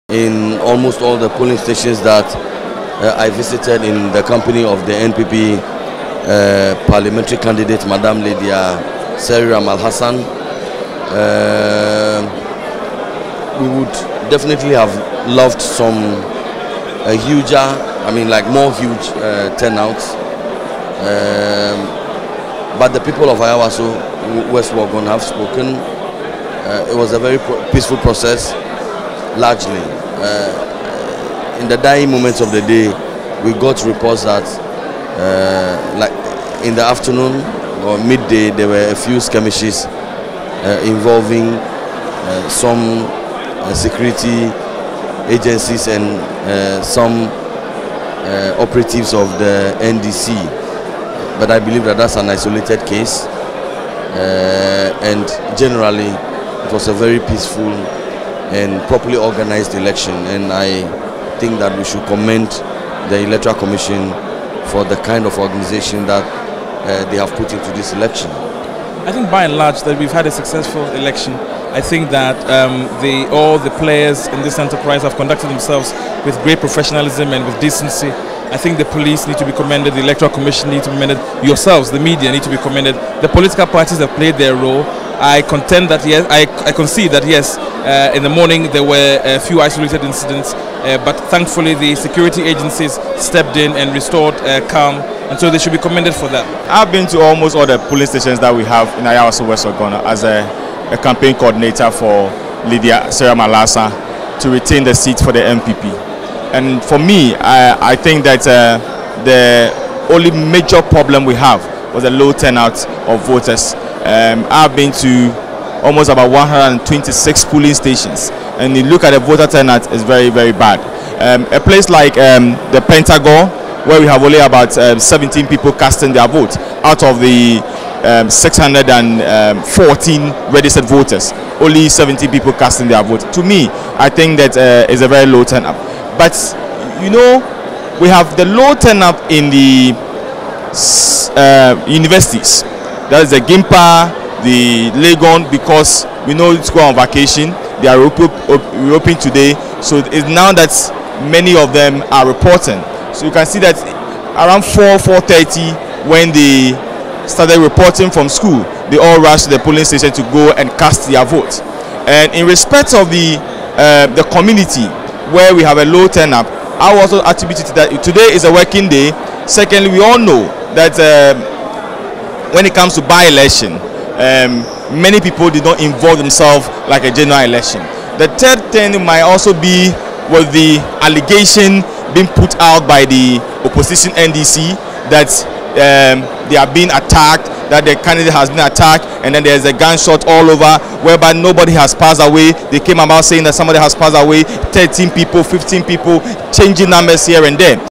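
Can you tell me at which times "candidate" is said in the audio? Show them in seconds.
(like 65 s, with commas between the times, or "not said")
7 s, 188 s.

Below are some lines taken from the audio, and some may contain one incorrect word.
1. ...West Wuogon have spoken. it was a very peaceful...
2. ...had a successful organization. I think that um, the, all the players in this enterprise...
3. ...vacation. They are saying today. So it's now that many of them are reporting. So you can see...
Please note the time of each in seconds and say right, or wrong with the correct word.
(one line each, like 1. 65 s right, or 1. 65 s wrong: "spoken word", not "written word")
1. 24 s right
2. 70 s wrong: "election", not "organization"
3. 146 s wrong: "reopening", not "saying".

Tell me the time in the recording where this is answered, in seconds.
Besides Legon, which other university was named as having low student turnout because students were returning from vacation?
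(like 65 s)
143 s.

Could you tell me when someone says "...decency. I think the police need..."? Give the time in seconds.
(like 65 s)
77 s.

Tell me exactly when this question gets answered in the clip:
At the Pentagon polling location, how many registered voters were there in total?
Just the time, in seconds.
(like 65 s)
128 s.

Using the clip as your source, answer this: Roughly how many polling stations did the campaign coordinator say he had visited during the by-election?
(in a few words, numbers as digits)
126.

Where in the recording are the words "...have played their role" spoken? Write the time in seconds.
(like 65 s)
83 s.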